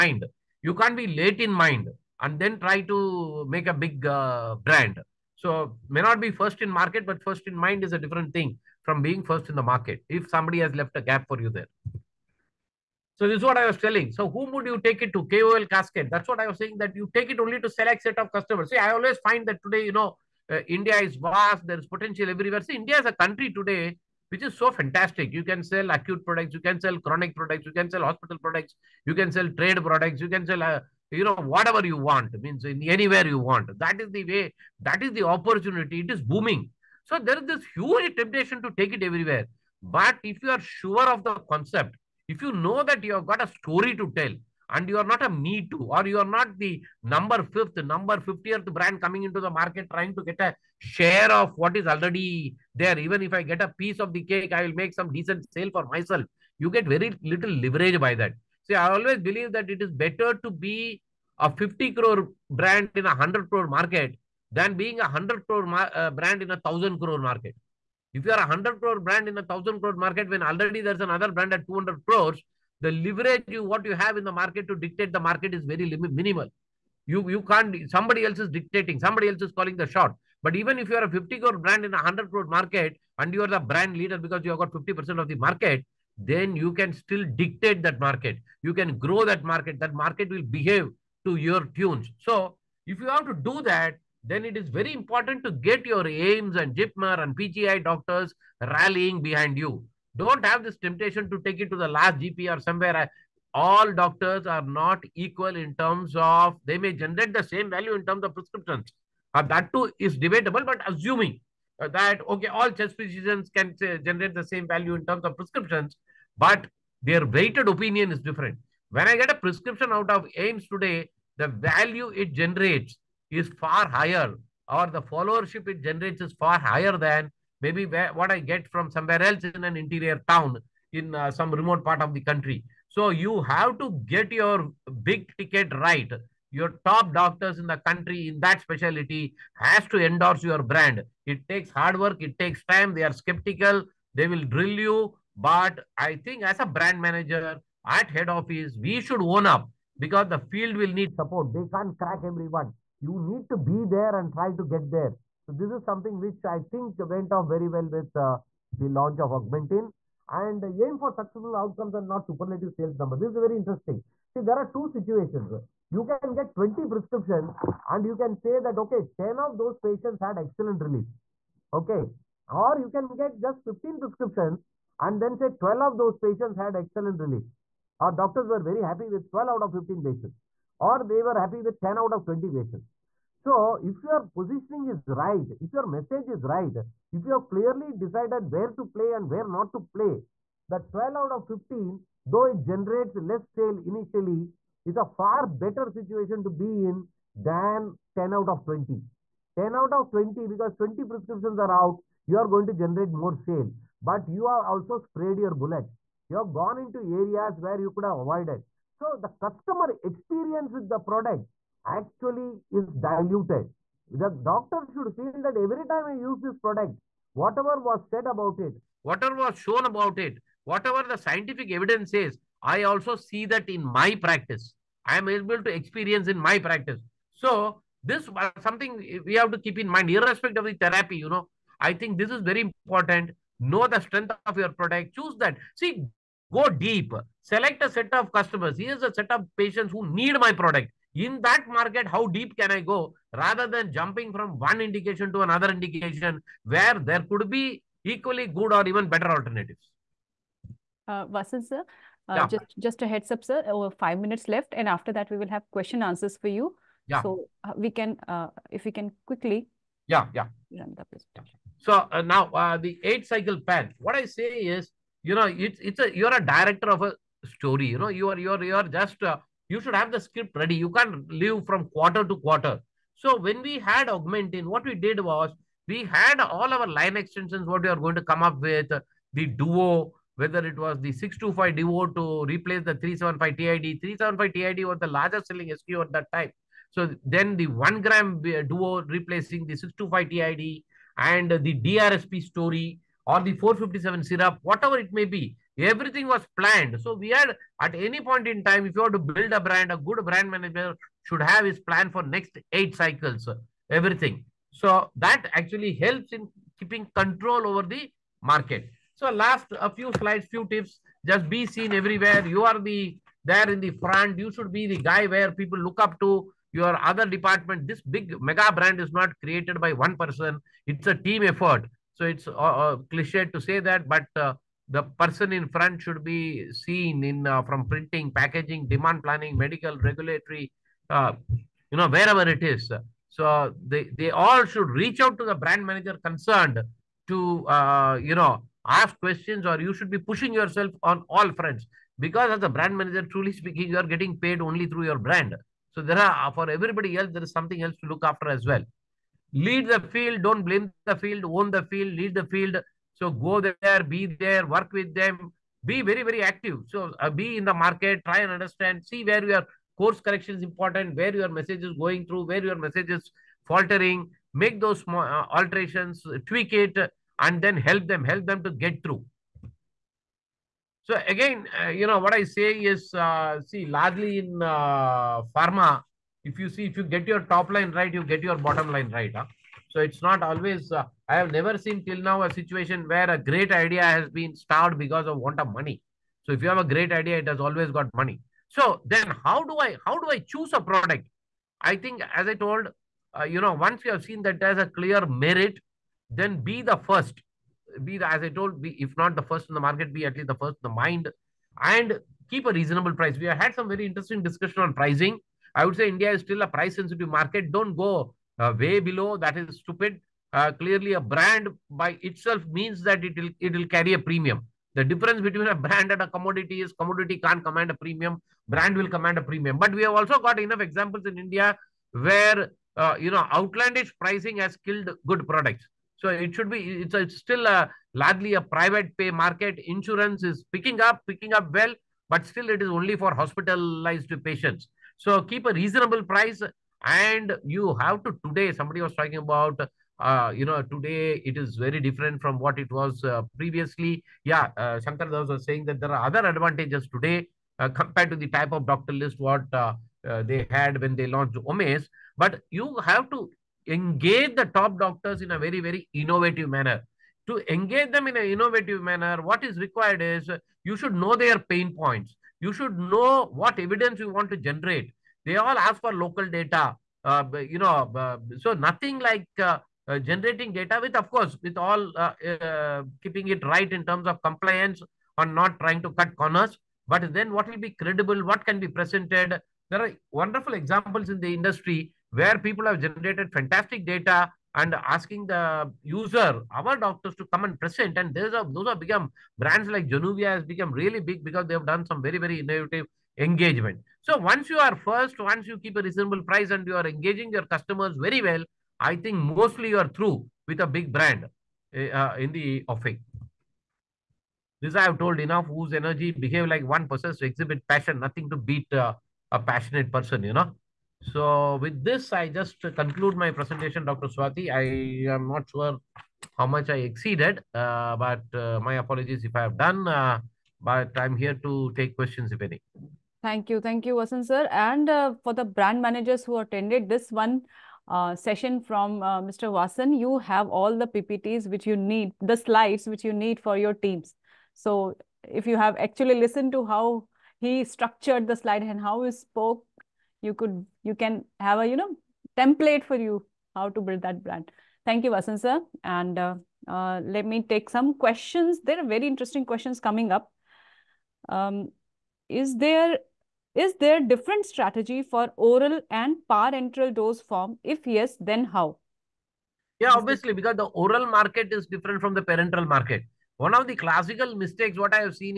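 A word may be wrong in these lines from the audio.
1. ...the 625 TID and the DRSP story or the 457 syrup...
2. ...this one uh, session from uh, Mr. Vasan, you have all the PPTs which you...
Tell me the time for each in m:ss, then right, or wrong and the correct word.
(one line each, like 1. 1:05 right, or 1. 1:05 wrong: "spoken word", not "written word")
1. 4:49 right
2. 8:47 right.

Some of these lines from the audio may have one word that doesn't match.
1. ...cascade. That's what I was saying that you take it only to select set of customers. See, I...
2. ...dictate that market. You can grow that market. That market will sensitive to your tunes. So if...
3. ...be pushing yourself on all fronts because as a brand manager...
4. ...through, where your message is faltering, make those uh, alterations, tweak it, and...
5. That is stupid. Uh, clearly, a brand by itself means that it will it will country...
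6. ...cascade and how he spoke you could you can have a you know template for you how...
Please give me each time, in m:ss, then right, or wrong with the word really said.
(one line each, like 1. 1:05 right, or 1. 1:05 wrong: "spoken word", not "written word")
1. 0:15 right
2. 1:27 wrong: "behave", not "sensitive"
3. 5:40 right
4. 6:02 right
5. 6:49 wrong: "carry", not "country"
6. 8:58 wrong: "slide", not "cascade".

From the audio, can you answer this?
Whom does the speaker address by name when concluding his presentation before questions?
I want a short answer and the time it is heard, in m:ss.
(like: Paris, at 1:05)
Dr. Swati, at 8:34.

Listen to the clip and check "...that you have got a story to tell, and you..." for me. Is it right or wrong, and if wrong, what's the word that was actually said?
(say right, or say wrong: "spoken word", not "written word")
right.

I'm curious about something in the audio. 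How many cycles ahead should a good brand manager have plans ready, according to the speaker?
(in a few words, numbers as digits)
8.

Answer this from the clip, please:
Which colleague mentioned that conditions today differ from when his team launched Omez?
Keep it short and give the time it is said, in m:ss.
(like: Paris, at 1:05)
Shankar Das, at 7:25.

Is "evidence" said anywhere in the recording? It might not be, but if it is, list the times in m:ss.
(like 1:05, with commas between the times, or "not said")
3:41, 7:43.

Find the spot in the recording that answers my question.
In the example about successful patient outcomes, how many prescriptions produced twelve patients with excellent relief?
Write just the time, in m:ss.
2:53.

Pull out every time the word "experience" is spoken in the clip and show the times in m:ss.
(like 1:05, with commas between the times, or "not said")
3:30, 3:45.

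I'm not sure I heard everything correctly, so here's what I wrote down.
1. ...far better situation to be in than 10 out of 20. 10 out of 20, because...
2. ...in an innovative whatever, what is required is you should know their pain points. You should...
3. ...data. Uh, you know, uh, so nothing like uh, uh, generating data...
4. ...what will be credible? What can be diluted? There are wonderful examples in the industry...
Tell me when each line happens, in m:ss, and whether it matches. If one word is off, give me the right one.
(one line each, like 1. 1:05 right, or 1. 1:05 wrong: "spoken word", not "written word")
1. 3:15 right
2. 7:38 wrong: "manner", not "whatever"
3. 7:46 right
4. 7:57 wrong: "presented", not "diluted".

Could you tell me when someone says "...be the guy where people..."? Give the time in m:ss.
5:14.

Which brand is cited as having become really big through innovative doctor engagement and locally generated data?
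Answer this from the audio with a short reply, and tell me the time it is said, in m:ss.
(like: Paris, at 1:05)
Januvia, at 8:10.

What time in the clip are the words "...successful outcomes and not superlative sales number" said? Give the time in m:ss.
2:41.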